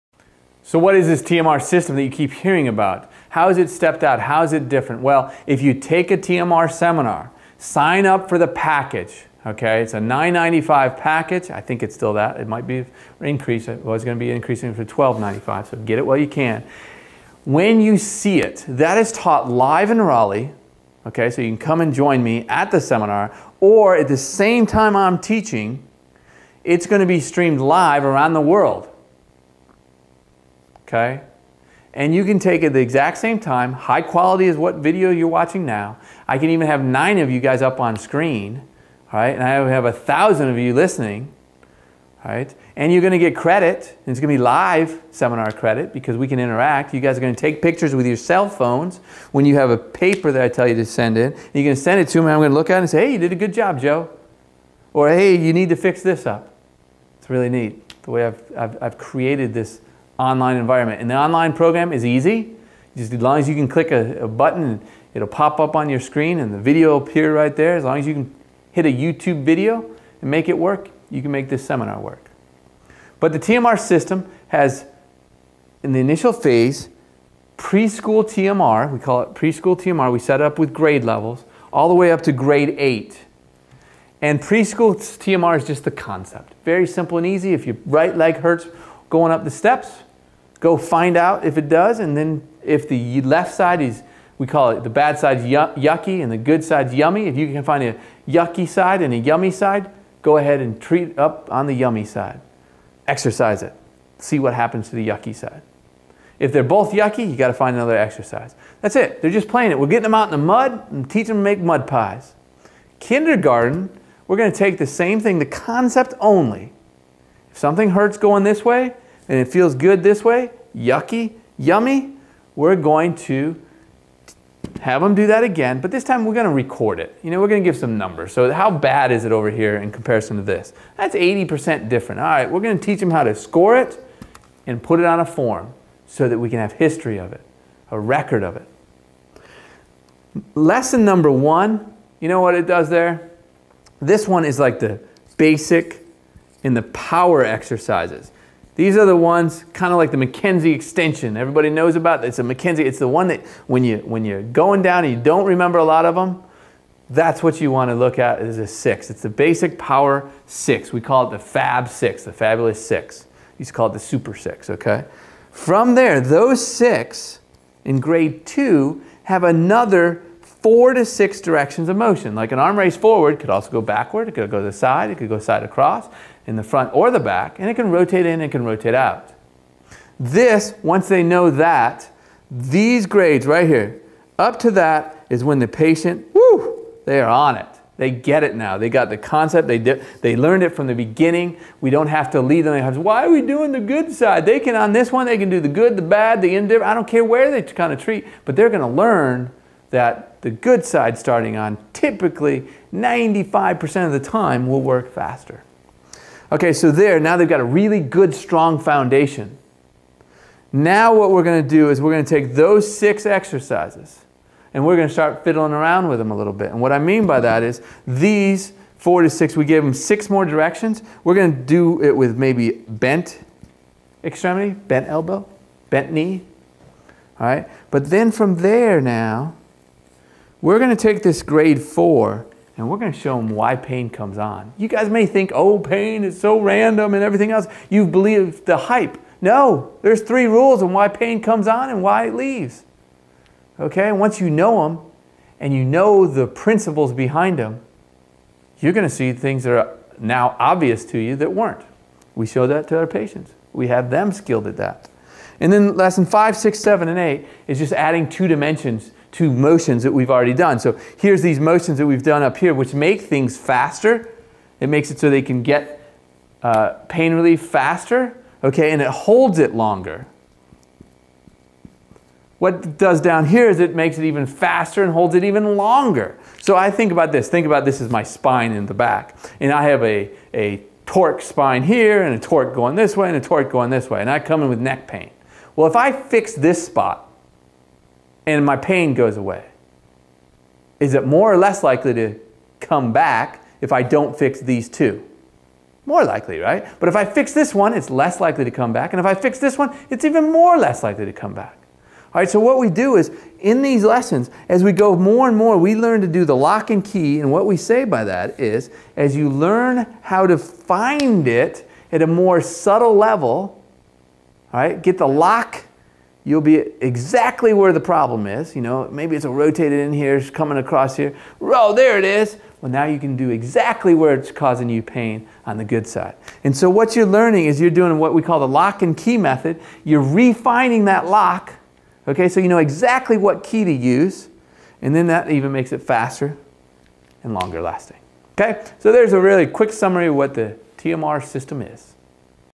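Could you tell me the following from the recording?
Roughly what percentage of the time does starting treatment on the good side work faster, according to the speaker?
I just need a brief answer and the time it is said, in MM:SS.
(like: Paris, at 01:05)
95%, at 03:22.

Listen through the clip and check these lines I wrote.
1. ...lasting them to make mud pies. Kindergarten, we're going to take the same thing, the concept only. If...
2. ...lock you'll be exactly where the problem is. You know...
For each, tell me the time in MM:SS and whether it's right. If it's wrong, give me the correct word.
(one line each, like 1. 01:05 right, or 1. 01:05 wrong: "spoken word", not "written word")
1. 01:51 wrong: "teaching", not "lasting"
2. 05:15 right.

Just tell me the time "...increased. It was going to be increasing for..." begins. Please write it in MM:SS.
00:13.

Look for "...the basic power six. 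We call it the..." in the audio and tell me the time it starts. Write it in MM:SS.
02:39.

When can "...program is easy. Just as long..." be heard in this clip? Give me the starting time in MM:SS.
01:01.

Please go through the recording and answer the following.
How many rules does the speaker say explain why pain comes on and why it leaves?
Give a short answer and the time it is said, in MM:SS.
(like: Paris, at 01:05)
3, at 04:00.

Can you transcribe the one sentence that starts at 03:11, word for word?
We don't have to lead them.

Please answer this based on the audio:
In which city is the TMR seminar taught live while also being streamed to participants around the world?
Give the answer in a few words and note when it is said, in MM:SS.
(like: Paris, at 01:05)
Raleigh, at 00:19.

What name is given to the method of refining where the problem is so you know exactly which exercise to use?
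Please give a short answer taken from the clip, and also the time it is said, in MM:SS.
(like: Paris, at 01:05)
lock and key method, at 05:28.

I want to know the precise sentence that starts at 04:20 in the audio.
So here's these motions that we've done up here, which make things faster.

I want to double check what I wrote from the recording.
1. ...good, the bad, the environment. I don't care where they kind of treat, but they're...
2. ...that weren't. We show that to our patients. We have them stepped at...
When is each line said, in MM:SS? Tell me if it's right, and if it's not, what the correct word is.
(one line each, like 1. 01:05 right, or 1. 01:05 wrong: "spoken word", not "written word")
1. 03:15 wrong: "indifferent", not "environment"
2. 04:11 wrong: "skilled", not "stepped".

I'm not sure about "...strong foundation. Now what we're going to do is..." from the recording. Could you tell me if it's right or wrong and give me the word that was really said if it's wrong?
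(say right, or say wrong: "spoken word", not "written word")
right.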